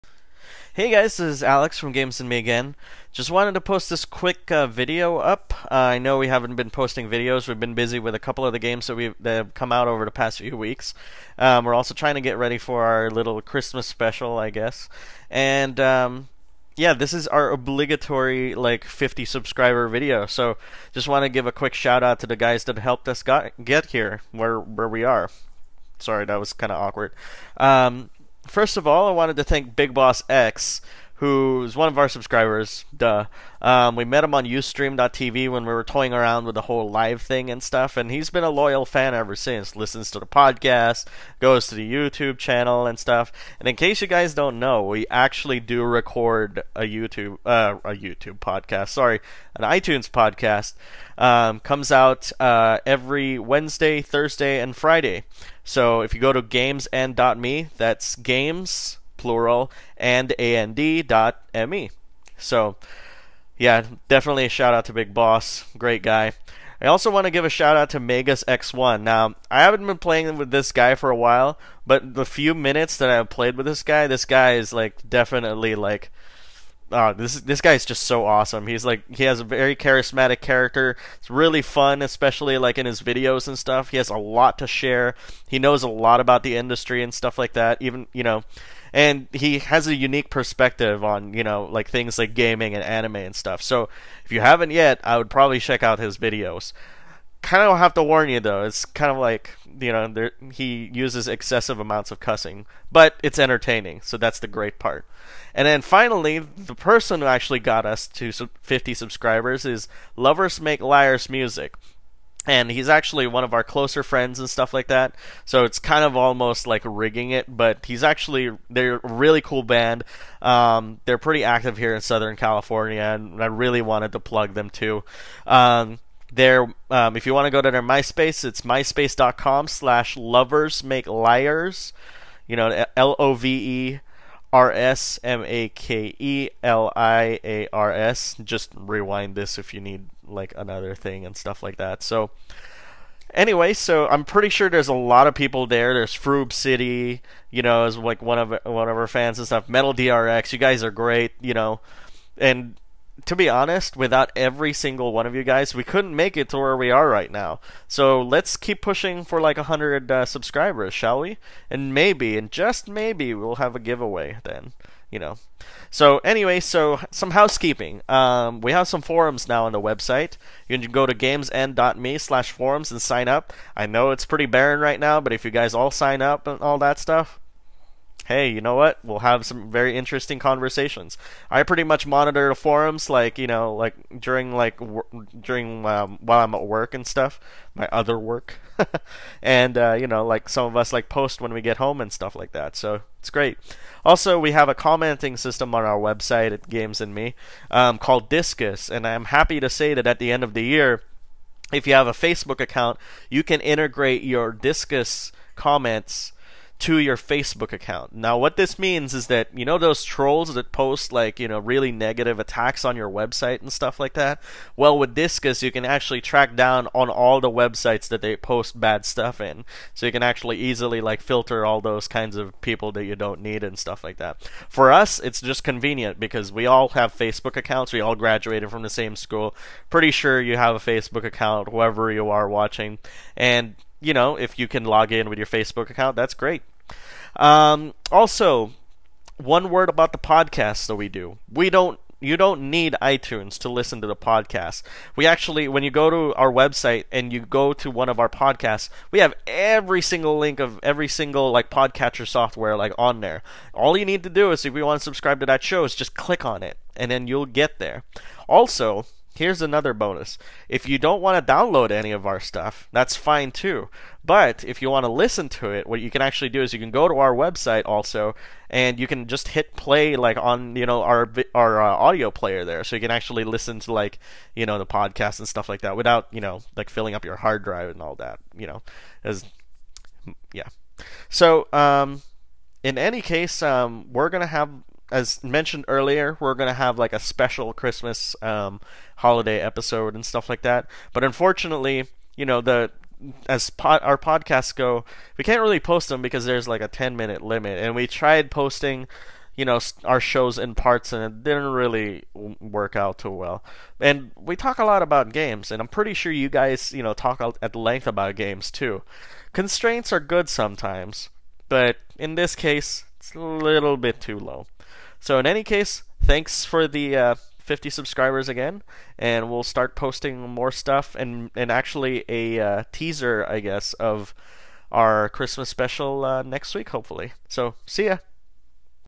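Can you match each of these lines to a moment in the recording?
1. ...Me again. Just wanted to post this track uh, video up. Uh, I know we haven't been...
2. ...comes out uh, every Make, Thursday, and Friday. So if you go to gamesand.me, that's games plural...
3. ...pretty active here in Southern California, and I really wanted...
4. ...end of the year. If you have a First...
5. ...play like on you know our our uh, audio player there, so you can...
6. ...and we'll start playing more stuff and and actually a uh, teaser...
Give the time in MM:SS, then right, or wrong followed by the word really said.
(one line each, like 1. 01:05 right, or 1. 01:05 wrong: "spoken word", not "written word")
1. 00:02 wrong: "quick", not "track"
2. 00:51 wrong: "Wednesday", not "Make"
3. 02:01 right
4. 03:20 wrong: "Facebook", not "First"
5. 04:29 right
6. 05:19 wrong: "posting", not "playing".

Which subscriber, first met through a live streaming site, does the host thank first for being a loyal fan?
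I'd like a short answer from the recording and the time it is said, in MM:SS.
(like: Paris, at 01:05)
Big Boss X, at 00:29.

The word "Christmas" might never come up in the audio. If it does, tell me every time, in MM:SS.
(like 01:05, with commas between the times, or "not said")
00:13, 04:47, 05:25.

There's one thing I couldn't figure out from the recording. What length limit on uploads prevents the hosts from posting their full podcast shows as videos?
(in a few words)
10 minutes.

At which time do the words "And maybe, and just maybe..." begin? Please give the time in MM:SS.
02:41.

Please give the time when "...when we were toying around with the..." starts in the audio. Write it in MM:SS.
00:35.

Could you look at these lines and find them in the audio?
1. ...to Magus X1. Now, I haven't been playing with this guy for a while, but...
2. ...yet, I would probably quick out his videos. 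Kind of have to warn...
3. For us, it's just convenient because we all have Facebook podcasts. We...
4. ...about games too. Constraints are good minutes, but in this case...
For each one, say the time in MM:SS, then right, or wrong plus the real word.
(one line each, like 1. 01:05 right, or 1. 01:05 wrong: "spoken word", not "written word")
1. 01:07 right
2. 01:34 wrong: "check", not "quick"
3. 03:44 wrong: "accounts", not "podcasts"
4. 05:08 wrong: "sometimes", not "minutes".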